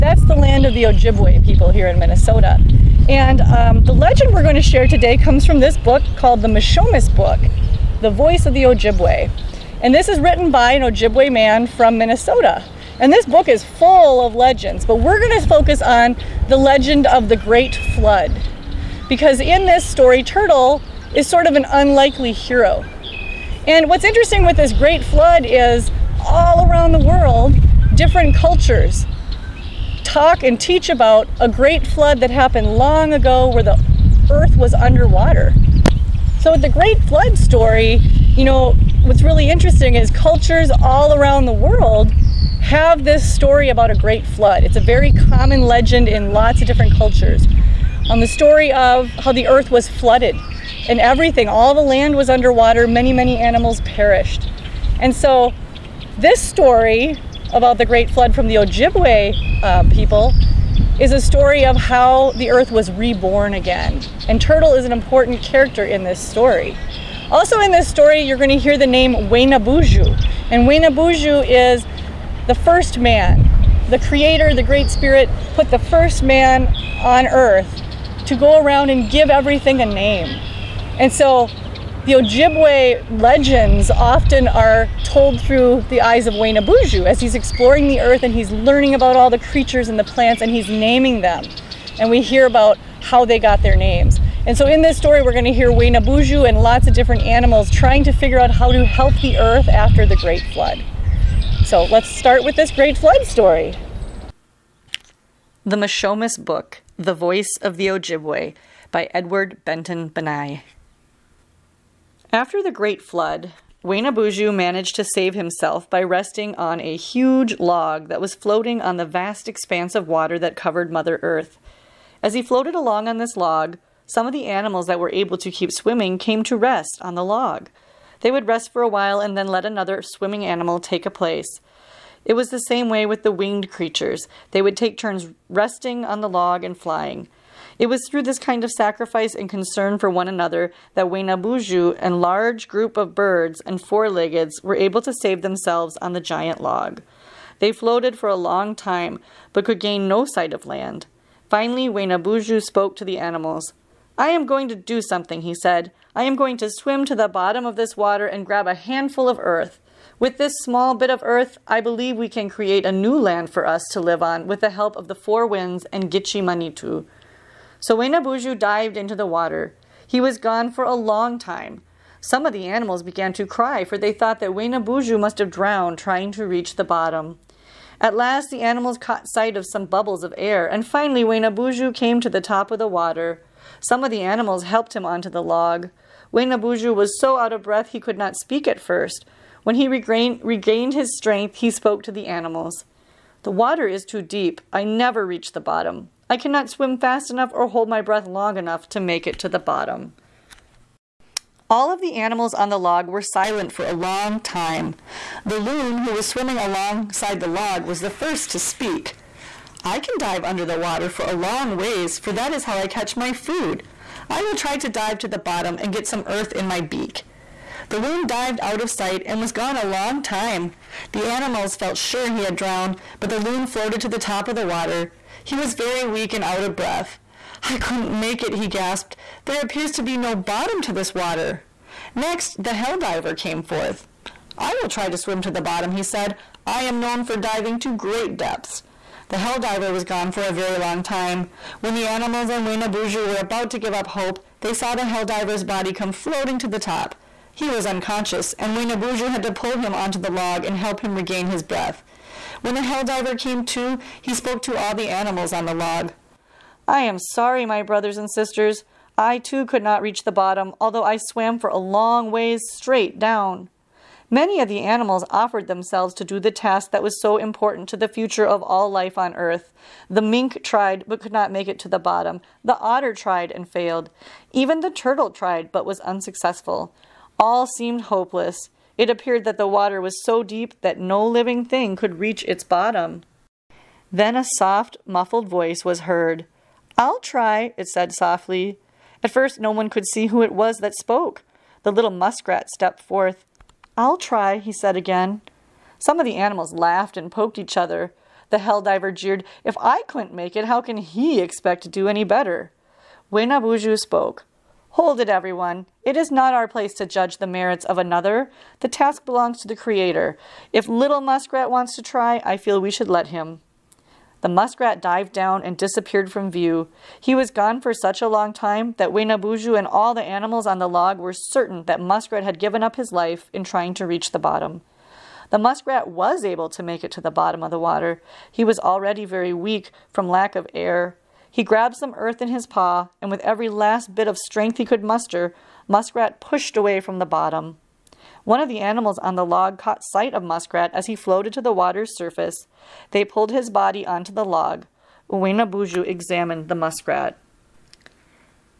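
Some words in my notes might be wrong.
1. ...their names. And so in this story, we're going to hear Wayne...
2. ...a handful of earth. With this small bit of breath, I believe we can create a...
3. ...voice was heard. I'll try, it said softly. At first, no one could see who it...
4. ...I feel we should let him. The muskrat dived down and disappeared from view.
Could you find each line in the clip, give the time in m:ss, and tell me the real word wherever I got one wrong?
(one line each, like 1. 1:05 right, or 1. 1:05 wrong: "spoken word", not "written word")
1. 1:33 right
2. 2:38 wrong: "earth", not "breath"
3. 4:45 right
4. 5:12 right.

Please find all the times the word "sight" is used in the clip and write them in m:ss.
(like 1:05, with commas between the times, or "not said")
2:30, 2:59, 3:38, 5:40.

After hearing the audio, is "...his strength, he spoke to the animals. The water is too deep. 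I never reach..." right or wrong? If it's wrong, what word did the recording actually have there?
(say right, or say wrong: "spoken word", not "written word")
right.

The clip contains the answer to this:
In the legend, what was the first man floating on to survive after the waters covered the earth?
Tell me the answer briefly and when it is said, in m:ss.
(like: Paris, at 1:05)
a huge log, at 1:56.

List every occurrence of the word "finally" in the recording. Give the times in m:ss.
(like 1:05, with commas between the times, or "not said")
2:31, 3:00.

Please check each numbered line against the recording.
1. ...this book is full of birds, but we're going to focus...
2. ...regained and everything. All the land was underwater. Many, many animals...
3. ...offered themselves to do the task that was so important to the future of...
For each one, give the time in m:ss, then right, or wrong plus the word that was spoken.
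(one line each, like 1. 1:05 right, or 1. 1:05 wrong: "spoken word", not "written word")
1. 0:13 wrong: "legends", not "birds"
2. 0:49 wrong: "flooded", not "regained"
3. 4:25 right.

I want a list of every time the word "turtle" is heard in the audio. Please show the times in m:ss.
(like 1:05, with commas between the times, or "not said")
0:20, 1:04, 4:34.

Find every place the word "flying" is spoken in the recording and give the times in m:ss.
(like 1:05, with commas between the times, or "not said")
2:16.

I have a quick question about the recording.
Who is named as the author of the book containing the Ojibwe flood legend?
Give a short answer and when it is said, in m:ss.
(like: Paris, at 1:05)
Edward Benton Banai, at 1:49.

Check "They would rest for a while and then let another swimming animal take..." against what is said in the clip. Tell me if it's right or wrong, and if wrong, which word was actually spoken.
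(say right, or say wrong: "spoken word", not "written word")
right.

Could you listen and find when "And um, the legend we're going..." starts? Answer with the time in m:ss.
0:03.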